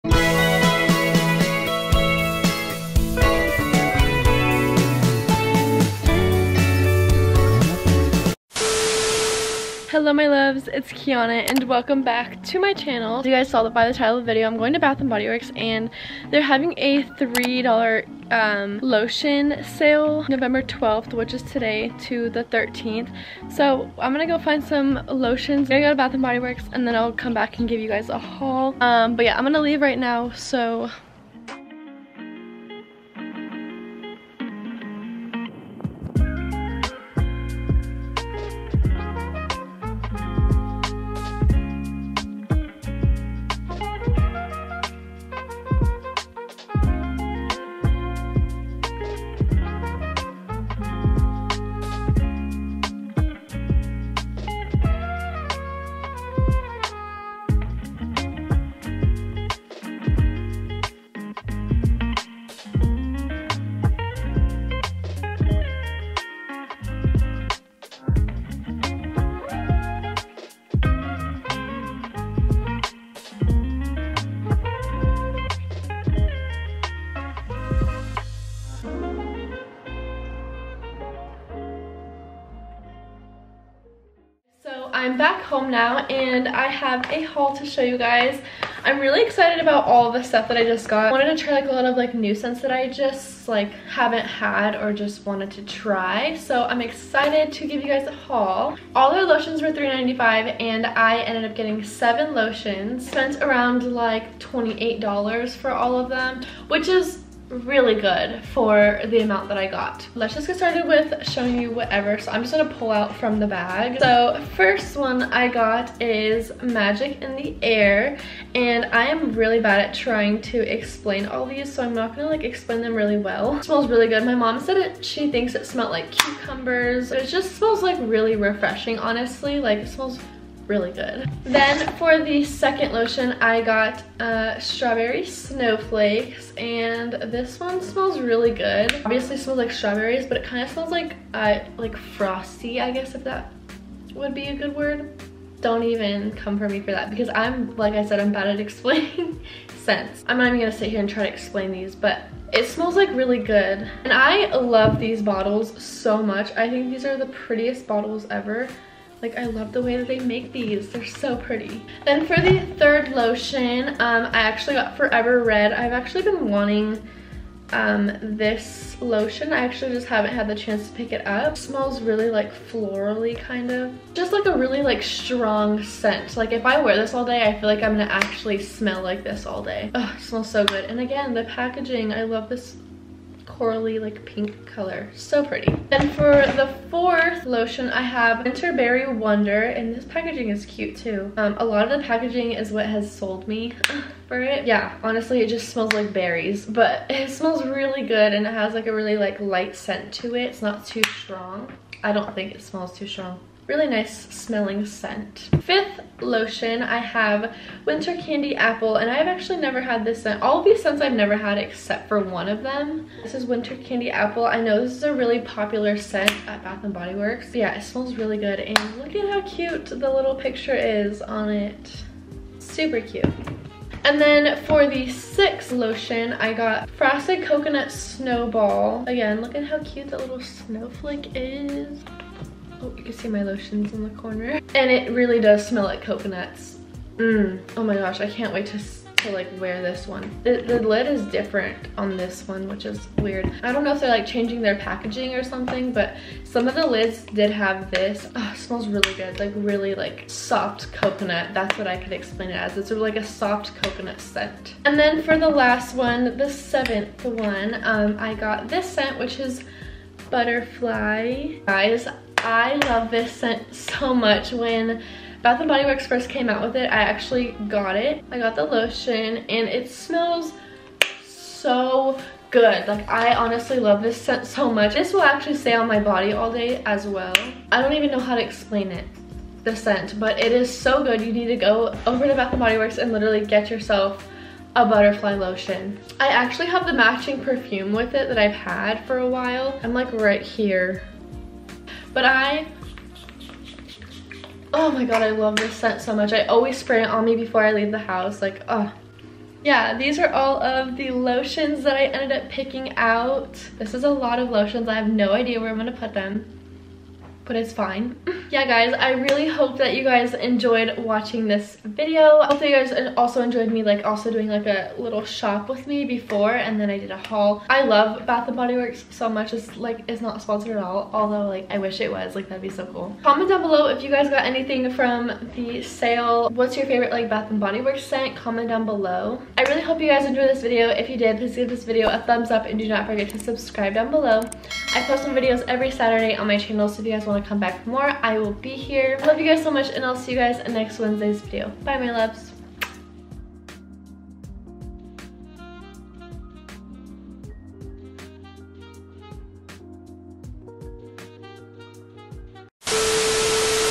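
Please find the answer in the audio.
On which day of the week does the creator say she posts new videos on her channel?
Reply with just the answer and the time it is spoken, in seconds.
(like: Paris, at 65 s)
Saturday, at 335 s.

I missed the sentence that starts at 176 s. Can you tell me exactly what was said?
Like if I wear this all day, I feel like I'm gonna actually smell like this all day.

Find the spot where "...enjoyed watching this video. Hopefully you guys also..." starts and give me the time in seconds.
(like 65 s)
310 s.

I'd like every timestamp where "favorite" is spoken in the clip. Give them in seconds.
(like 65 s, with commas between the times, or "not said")
326 s.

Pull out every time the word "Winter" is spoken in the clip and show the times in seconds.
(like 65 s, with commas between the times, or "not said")
188 s, 207 s, 213 s.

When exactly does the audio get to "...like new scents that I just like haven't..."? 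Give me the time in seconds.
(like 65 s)
91 s.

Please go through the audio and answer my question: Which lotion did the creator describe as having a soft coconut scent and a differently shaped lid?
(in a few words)
Frosted Coconut Snowball.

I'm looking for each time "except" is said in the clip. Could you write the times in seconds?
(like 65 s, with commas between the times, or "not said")
211 s.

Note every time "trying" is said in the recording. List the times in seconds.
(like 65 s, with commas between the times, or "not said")
119 s.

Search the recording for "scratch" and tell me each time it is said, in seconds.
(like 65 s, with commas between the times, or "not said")
not said.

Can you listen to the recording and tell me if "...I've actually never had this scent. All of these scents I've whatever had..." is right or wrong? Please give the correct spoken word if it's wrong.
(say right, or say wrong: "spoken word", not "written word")
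wrong: "never", not "whatever".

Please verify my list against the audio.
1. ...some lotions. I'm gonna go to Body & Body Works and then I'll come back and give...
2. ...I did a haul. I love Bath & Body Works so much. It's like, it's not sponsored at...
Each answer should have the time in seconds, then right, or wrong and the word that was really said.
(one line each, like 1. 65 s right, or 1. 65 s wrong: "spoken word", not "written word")
1. 24 s wrong: "Bath", not "Body"
2. 316 s right.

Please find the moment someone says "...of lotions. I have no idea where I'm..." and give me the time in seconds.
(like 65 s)
304 s.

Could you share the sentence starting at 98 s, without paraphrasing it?
All their lotions were $3.95 and I ended up getting seven lotions.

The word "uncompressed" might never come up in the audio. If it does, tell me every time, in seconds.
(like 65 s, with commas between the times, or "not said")
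not said.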